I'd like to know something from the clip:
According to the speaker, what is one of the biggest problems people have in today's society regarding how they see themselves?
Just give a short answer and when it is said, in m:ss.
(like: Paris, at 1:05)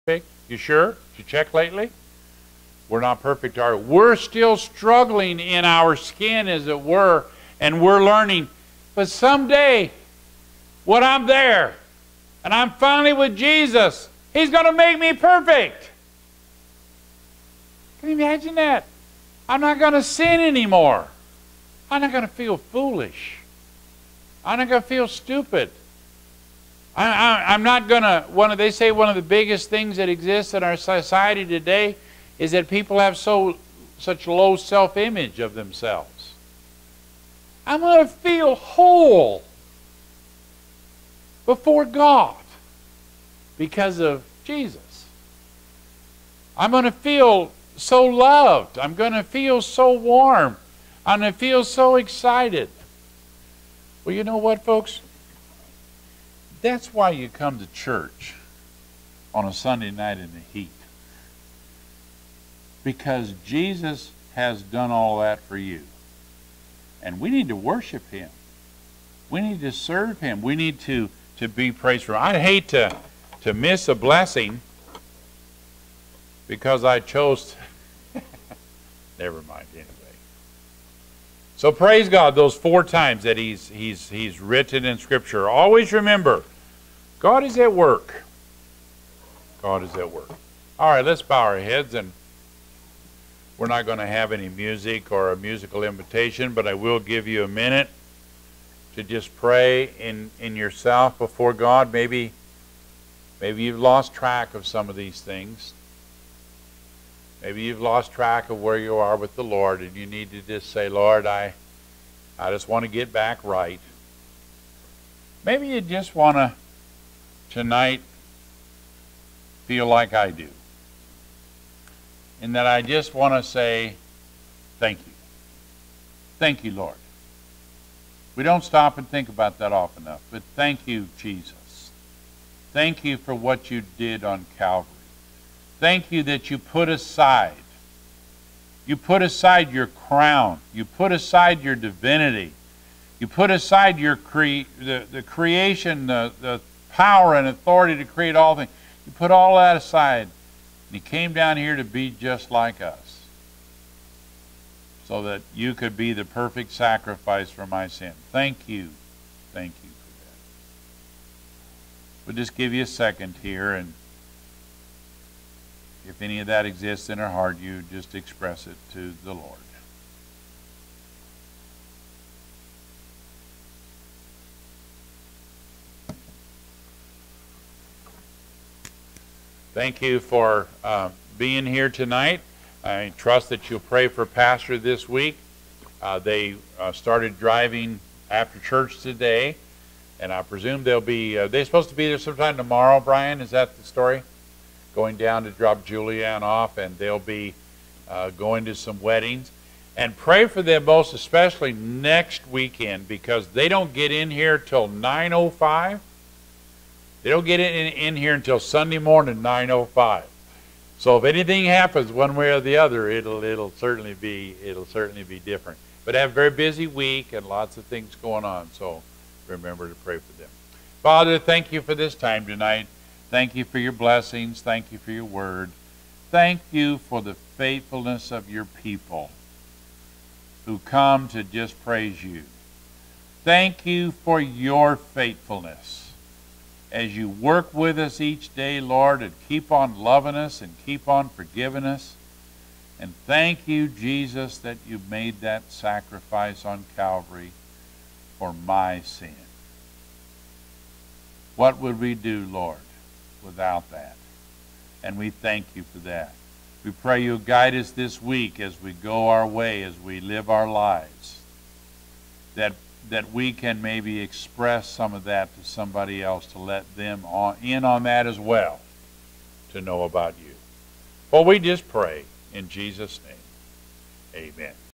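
Low self-image, at 0:34.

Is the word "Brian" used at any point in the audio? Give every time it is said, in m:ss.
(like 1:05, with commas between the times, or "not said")
3:12.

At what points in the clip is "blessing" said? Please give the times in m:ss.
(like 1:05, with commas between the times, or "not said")
1:13, 3:43.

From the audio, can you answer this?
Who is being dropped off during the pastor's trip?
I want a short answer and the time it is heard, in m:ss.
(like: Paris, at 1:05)
Julianne, at 3:15.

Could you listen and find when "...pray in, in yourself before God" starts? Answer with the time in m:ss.
1:39.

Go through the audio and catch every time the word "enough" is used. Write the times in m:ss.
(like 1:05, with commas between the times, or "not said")
2:10.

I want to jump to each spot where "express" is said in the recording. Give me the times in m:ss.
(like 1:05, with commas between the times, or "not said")
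2:48, 4:24.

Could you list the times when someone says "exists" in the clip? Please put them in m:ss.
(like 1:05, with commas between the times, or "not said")
0:30, 2:46.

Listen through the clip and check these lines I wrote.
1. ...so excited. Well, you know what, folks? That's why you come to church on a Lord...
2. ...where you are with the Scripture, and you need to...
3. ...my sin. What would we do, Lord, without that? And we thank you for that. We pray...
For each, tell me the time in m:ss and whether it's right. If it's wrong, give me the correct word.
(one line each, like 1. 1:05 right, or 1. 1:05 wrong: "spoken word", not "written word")
1. 0:51 wrong: "Sunday", not "Lord"
2. 1:48 wrong: "Lord", not "Scripture"
3. 4:08 right.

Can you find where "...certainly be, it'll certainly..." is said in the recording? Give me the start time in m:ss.
3:33.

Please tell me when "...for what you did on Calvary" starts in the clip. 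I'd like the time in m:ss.
2:13.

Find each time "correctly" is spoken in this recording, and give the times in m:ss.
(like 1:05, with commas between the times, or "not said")
not said.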